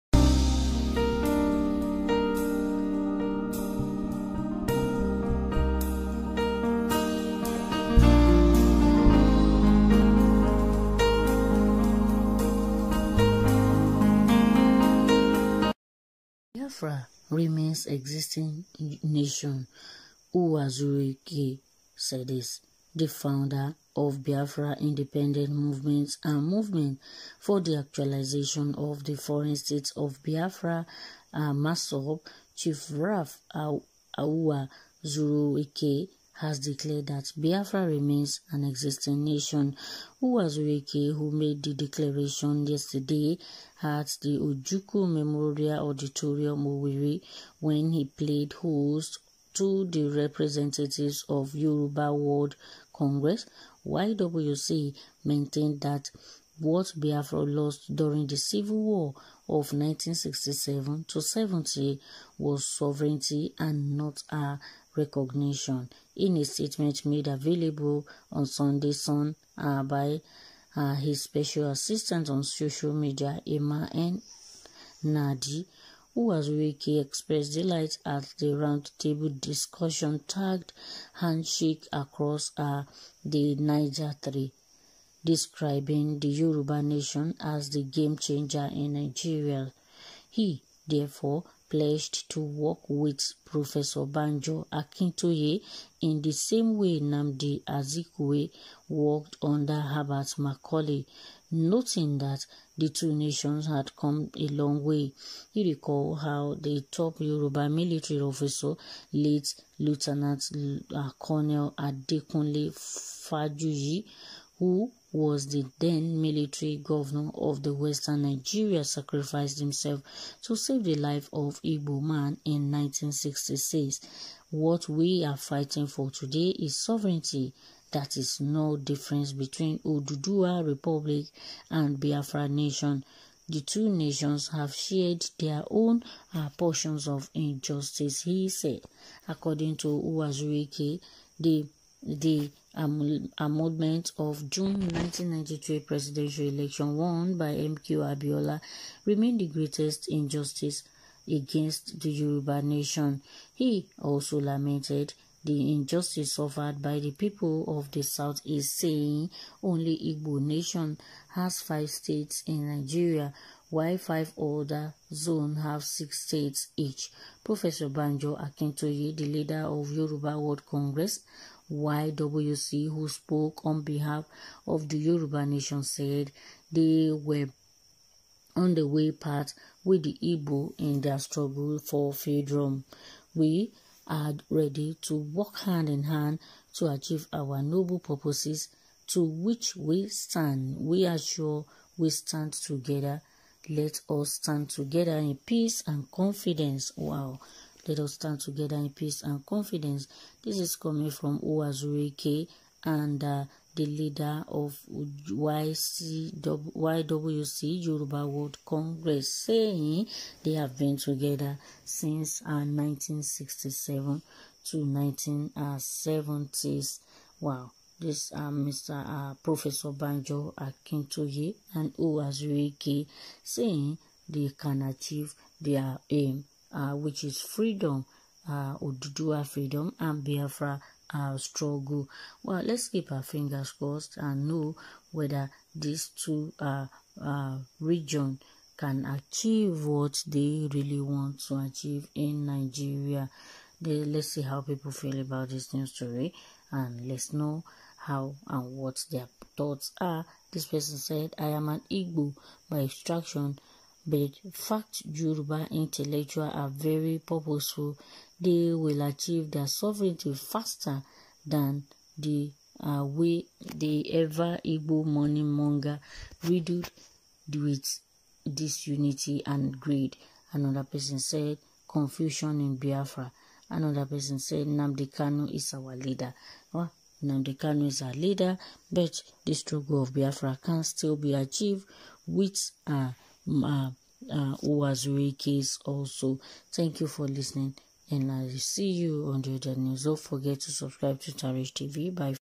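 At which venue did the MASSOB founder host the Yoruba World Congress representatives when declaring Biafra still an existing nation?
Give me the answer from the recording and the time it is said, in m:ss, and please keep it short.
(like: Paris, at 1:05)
Ojukwu Memorial Auditorium, at 0:44.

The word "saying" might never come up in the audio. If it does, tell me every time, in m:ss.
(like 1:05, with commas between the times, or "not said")
2:38, 3:29, 3:43.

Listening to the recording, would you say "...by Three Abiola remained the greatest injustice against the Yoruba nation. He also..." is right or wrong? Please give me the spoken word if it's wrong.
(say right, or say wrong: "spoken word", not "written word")
wrong: "MKO", not "Three".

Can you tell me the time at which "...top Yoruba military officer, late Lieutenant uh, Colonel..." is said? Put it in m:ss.
1:46.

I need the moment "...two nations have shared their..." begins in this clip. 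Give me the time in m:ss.
2:13.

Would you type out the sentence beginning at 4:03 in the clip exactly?
They, let's see how people feel about this new story and let's know how and what their thoughts are.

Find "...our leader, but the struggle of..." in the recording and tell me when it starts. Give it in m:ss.
4:38.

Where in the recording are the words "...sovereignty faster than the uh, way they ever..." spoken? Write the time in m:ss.
4:19.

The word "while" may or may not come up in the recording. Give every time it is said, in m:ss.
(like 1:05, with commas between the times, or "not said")
2:43.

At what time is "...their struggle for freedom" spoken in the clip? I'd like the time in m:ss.
3:01.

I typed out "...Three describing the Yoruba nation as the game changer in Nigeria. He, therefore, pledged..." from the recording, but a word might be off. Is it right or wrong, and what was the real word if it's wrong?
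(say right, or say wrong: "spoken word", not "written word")
right.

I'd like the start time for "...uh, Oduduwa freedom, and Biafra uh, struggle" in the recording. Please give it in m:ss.
3:48.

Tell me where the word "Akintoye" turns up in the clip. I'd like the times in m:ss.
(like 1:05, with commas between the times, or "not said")
1:34, 2:48, 3:40.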